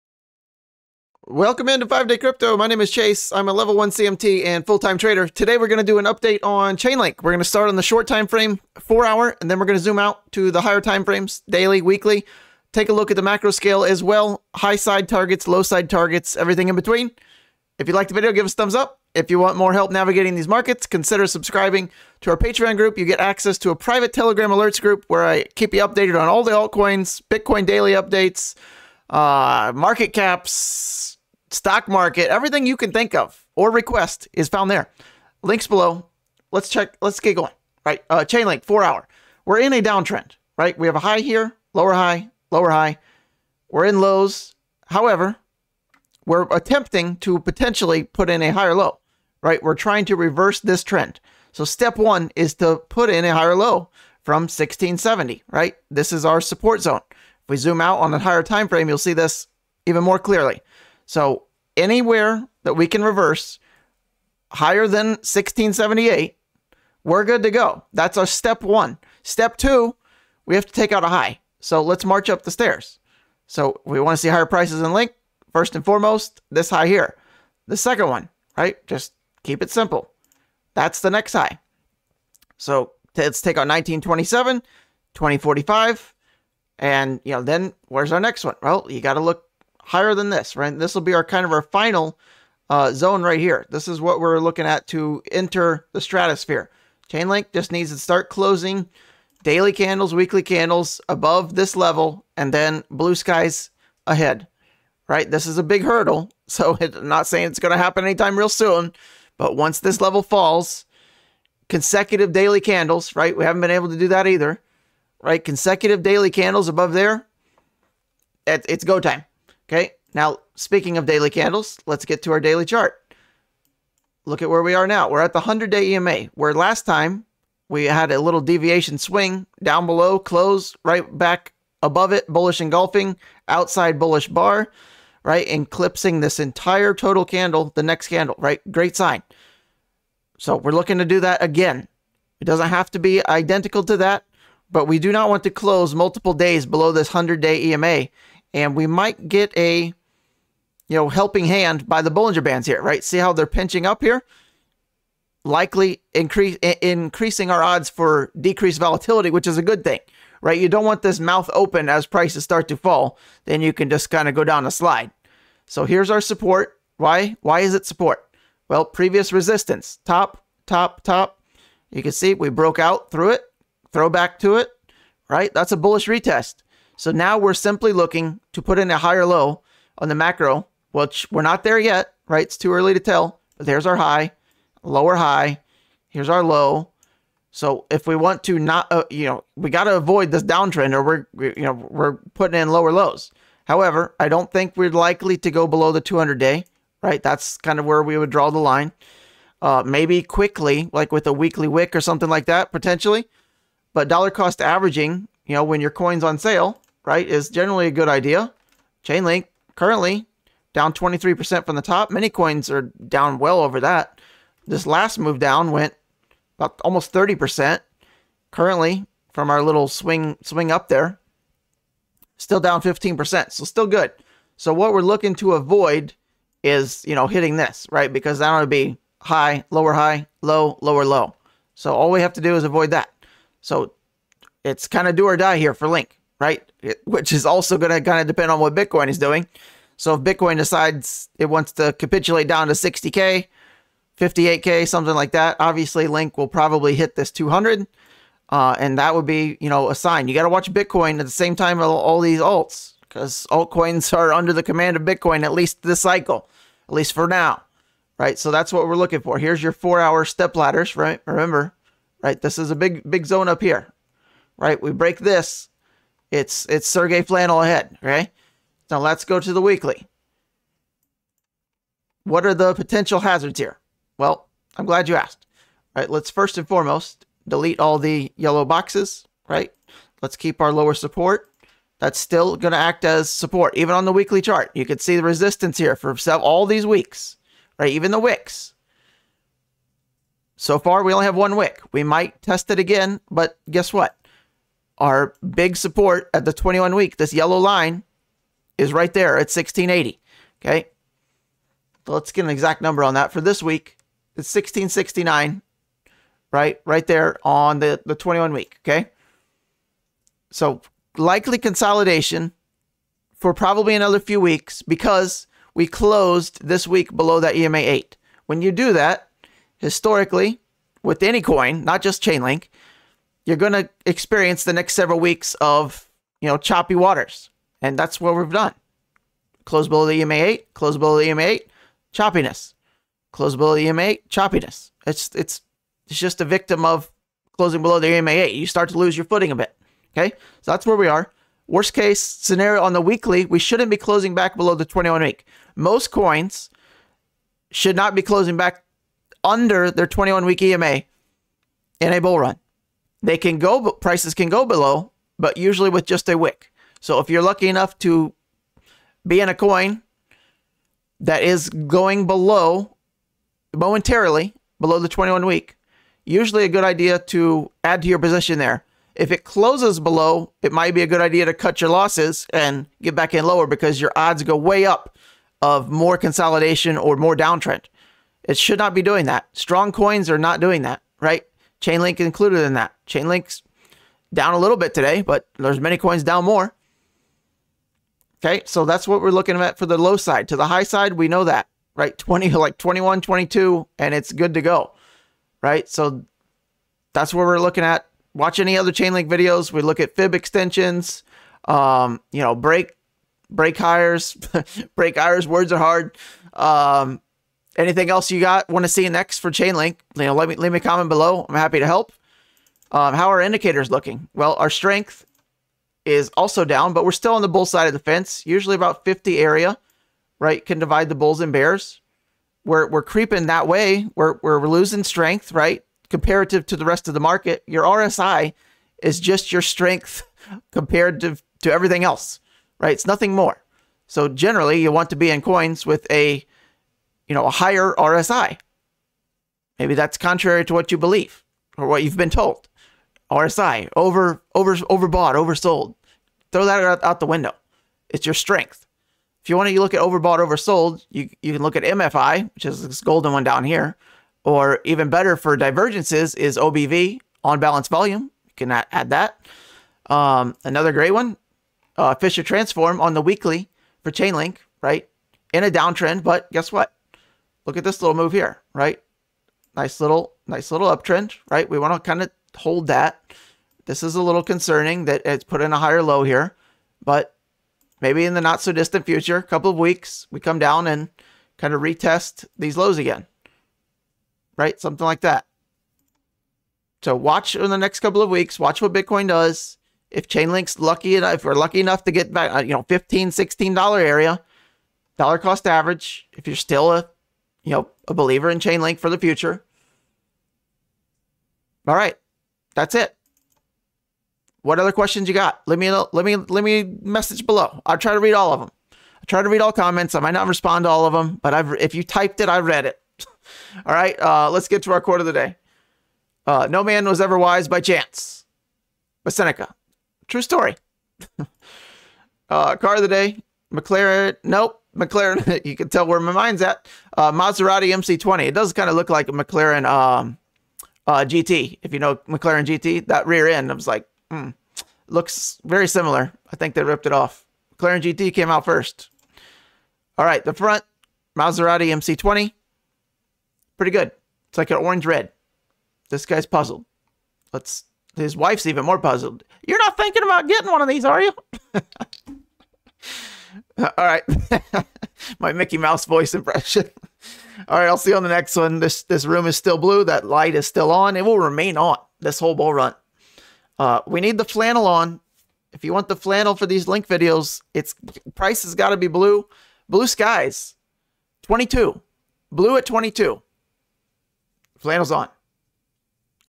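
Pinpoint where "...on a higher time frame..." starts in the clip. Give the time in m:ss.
0:57.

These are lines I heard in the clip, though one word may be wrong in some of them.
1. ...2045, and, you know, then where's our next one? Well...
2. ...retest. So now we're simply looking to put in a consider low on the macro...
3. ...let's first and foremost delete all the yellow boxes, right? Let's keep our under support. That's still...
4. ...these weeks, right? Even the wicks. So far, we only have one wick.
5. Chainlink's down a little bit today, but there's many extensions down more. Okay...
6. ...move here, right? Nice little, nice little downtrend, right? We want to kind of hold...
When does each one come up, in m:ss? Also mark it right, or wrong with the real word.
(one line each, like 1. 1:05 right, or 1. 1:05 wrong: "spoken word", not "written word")
1. 1:25 right
2. 2:56 wrong: "higher", not "consider"
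3. 4:36 wrong: "lower", not "under"
4. 4:46 right
5. 6:23 wrong: "coins", not "extensions"
6. 7:48 wrong: "uptrend", not "downtrend".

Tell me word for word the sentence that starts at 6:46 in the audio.
Um, anything else you got want to see next for Chainlink, you know, let me leave me a comment below.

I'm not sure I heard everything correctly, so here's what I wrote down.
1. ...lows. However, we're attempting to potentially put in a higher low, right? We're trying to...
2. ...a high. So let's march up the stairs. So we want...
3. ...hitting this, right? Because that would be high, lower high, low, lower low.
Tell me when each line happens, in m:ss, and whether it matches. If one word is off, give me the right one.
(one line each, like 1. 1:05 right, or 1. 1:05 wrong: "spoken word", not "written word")
1. 0:43 right
2. 1:11 right
3. 3:47 right.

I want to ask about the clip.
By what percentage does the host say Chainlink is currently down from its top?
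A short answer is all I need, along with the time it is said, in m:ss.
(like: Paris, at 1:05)
23%, at 3:30.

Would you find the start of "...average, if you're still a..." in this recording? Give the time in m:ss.
8:15.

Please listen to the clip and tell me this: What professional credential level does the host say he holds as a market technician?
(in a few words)
Level 1 CMT.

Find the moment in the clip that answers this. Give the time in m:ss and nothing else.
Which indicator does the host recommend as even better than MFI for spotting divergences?
7:36.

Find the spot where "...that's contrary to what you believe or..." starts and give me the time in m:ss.
7:19.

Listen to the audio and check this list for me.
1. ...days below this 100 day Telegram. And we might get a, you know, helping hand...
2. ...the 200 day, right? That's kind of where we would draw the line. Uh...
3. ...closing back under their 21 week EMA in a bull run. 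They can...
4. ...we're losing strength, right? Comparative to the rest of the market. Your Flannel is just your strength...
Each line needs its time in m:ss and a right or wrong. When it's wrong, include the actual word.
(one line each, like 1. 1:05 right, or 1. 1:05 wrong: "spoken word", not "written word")
1. 2:26 wrong: "EMA", not "Telegram"
2. 3:15 right
3. 5:48 right
4. 7:04 wrong: "RSI", not "Flannel".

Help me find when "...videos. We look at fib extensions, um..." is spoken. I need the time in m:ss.
6:39.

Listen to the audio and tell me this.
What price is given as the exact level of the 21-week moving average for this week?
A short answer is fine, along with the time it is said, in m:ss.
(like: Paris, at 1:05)
1669, at 5:04.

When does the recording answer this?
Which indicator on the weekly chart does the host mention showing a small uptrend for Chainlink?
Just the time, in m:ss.
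7:42.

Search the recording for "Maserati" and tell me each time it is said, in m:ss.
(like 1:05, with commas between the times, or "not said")
8:47, 9:01.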